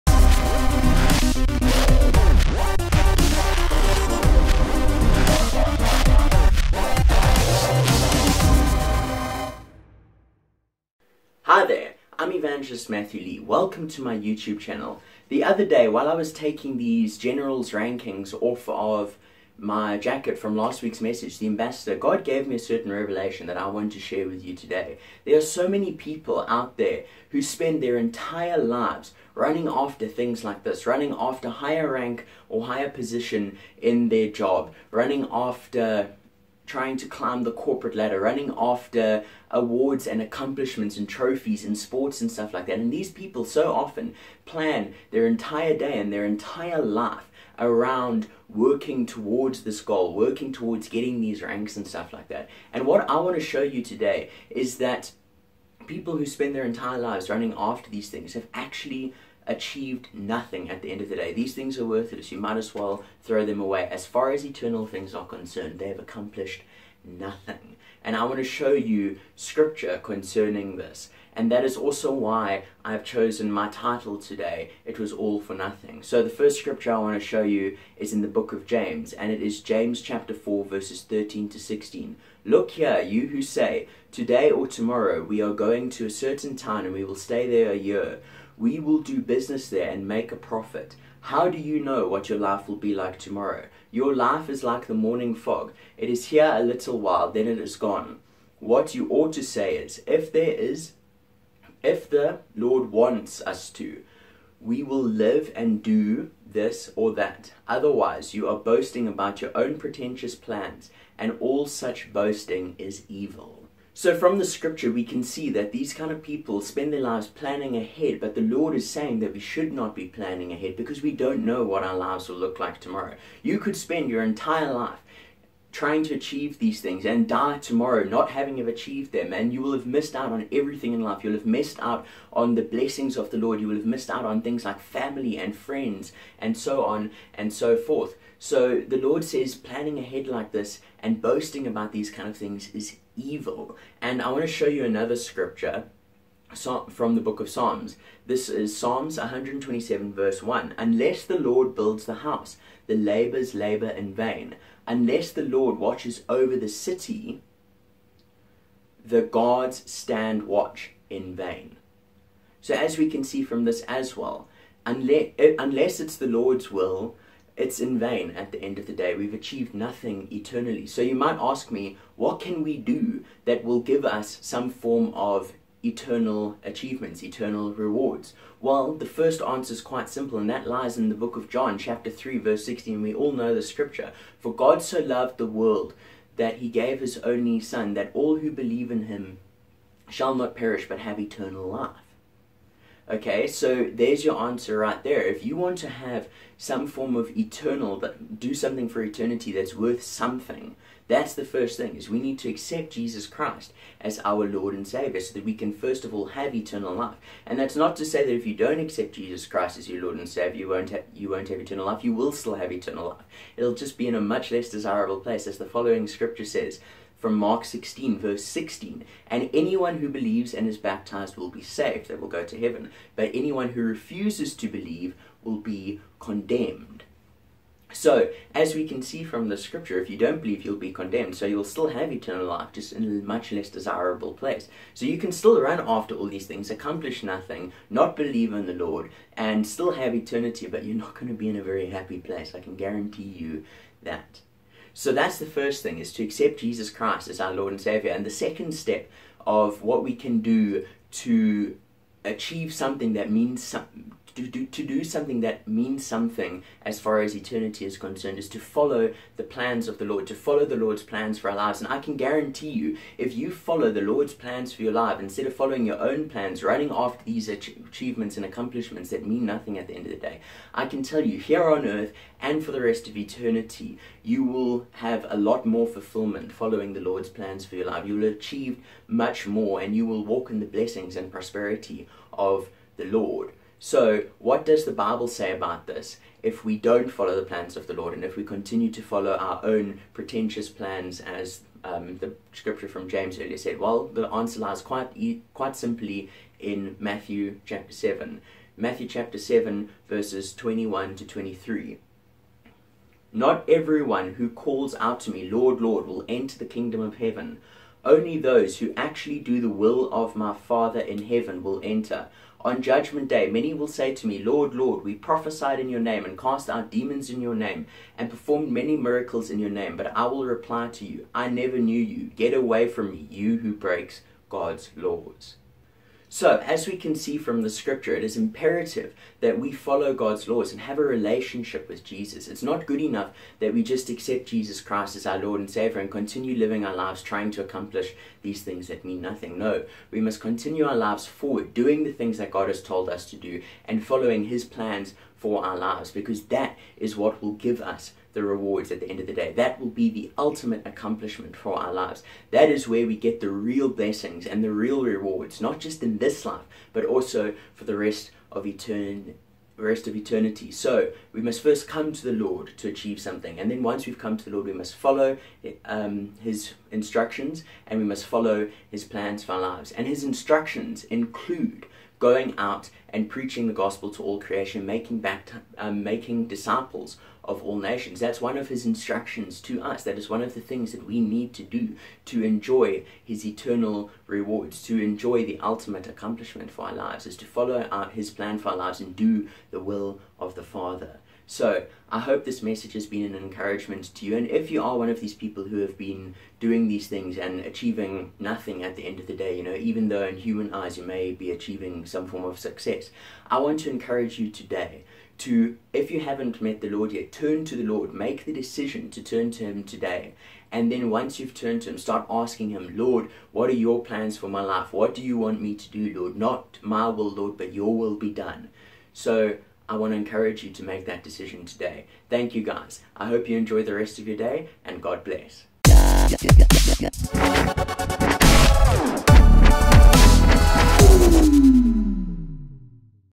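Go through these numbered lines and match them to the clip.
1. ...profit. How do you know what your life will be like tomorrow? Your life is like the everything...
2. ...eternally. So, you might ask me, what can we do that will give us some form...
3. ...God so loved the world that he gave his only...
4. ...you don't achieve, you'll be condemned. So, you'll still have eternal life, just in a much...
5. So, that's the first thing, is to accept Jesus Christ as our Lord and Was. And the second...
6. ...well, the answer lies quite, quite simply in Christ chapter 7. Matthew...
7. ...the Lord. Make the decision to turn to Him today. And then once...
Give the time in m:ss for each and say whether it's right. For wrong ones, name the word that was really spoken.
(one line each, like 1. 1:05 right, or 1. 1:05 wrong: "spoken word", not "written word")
1. 1:30 wrong: "morning", not "everything"
2. 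2:50 right
3. 3:04 right
4. 3:50 wrong: "believe", not "achieve"
5. 4:04 wrong: "Savior", not "Was"
6. 4:53 wrong: "Matthew", not "Christ"
7. 6:47 right.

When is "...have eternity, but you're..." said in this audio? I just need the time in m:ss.
3:59.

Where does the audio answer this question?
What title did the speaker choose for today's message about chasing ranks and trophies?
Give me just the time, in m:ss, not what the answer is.
1:14.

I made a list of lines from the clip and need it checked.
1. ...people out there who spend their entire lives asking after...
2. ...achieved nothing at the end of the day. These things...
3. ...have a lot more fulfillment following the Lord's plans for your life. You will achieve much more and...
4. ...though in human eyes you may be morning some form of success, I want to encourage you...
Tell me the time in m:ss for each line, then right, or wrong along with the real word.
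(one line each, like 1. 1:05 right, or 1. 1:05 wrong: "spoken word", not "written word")
1. 0:25 wrong: "running", not "asking"
2. 0:59 right
3. 4:34 right
4. 6:40 wrong: "achieving", not "morning".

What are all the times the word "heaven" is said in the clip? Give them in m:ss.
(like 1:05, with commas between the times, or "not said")
3:42, 5:07, 5:11.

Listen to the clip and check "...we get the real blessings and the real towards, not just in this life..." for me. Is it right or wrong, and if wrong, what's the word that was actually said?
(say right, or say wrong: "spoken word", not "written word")
wrong: "rewards", not "towards".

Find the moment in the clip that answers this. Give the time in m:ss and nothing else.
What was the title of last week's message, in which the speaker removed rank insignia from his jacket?
0:21.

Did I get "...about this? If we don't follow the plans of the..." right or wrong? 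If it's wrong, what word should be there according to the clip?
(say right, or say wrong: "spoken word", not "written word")
right.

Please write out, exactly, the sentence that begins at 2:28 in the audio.
This is Psalms 127, verse 1.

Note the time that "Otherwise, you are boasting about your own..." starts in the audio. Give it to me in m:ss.
1:47.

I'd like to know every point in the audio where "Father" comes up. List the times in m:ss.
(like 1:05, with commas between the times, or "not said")
5:10, 6:30.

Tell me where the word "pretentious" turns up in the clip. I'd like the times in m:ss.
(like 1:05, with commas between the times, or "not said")
1:49, 4:50.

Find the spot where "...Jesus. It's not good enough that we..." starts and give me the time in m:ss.
5:32.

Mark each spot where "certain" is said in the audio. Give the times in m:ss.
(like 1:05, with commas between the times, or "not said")
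0:22, 1:26.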